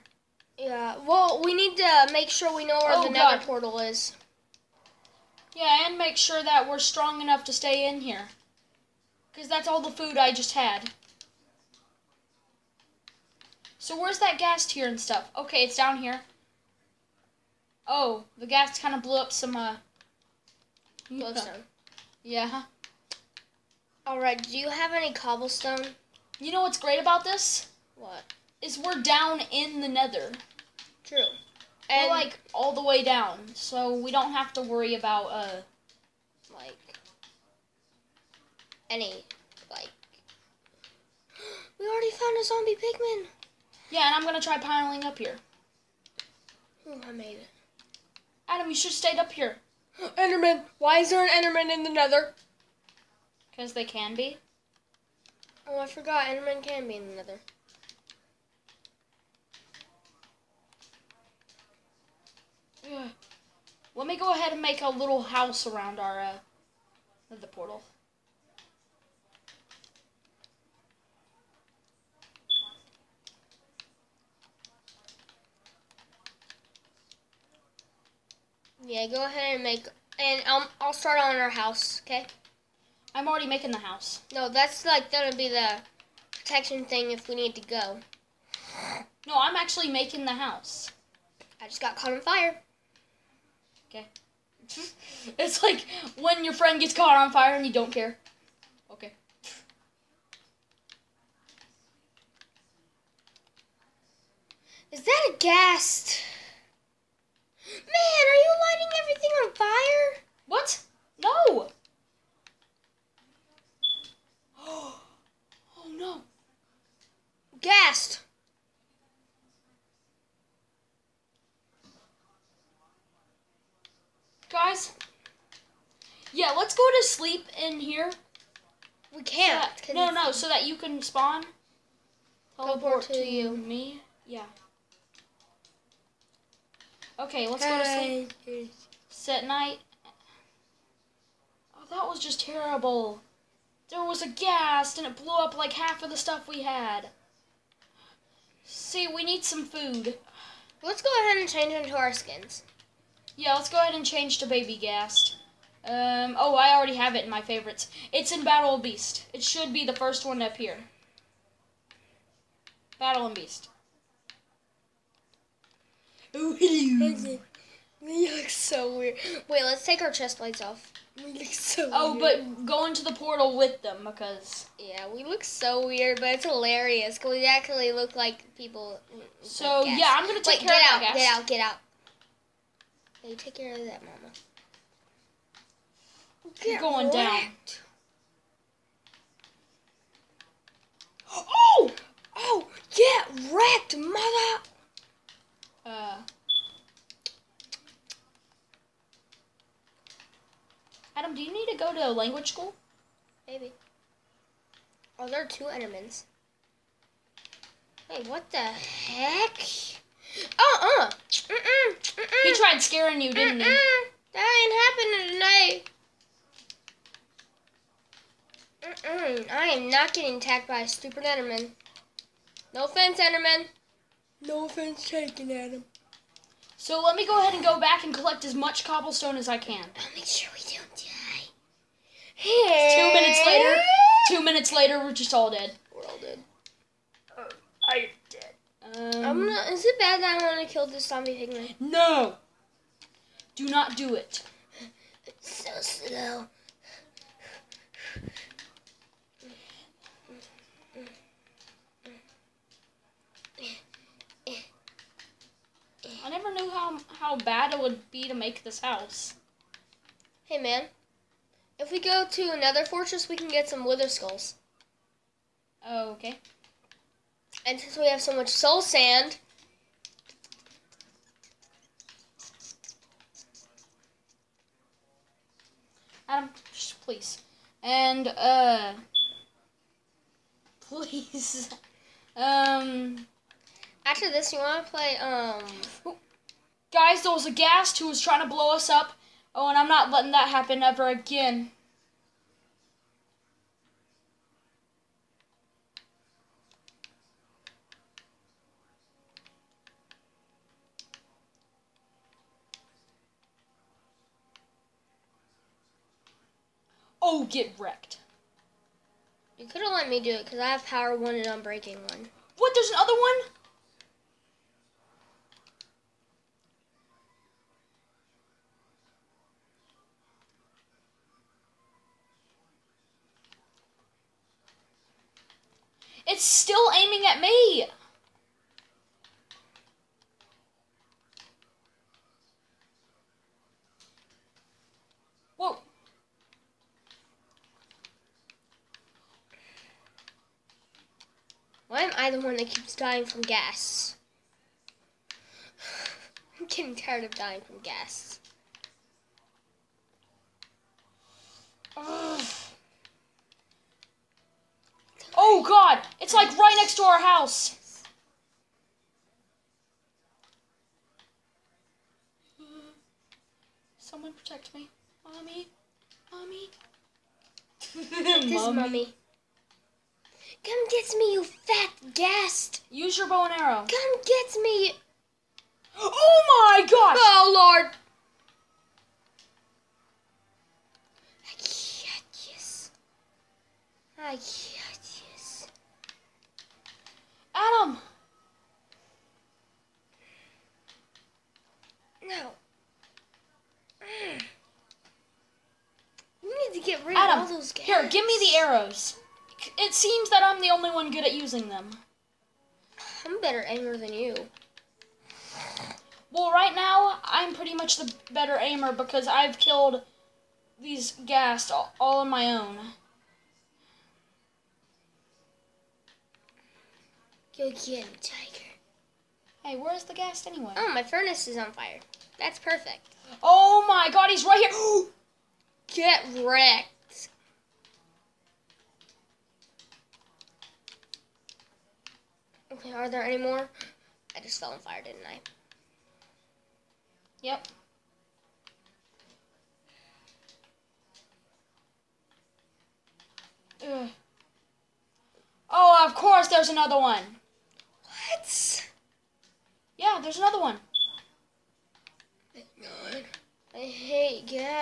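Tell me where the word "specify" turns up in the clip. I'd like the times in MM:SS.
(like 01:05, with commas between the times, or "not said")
not said.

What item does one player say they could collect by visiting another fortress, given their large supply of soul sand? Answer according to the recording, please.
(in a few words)
wither skulls.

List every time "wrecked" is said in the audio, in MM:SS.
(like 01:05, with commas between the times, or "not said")
03:07, 03:13, 05:07, 07:06.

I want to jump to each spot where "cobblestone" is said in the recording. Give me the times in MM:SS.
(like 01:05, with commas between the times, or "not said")
00:25, 03:48.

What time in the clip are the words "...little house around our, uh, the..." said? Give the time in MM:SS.
01:04.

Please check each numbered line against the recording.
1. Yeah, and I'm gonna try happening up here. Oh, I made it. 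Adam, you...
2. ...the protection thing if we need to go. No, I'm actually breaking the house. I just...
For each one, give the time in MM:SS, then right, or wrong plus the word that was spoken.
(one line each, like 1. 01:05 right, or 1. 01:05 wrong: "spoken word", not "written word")
1. 00:43 wrong: "piling", not "happening"
2. 01:25 wrong: "making", not "breaking".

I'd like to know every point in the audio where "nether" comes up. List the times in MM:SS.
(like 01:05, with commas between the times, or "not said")
00:03, 00:29, 00:51, 00:57.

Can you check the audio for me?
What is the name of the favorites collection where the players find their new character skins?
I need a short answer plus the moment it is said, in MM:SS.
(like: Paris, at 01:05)
Battle of Beast, at 02:38.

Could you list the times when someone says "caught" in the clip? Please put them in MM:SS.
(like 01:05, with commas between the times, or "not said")
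01:31, 01:36.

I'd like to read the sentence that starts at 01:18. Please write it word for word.
Yeah, go ahead and make, and um, I'll start on our house, okay?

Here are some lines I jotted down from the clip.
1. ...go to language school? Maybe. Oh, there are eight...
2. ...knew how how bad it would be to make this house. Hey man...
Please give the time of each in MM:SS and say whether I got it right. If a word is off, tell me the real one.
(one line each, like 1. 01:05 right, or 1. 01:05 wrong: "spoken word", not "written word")
1. 03:21 wrong: "two", not "eight"
2. 04:16 right.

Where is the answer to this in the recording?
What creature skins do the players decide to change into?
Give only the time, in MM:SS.
02:34.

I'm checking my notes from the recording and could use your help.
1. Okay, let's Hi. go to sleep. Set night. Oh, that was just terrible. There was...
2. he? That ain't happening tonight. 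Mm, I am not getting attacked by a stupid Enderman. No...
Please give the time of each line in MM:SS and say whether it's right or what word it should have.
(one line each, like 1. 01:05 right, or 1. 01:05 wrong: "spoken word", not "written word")
1. 02:17 right
2. 03:33 right.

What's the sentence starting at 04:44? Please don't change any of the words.
After this, you want to play, um...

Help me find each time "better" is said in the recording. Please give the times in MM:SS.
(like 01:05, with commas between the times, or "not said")
06:43, 06:48.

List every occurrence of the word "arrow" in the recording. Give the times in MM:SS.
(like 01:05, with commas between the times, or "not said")
06:13, 06:38.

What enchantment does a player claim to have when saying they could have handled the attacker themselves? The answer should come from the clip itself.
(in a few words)
power one.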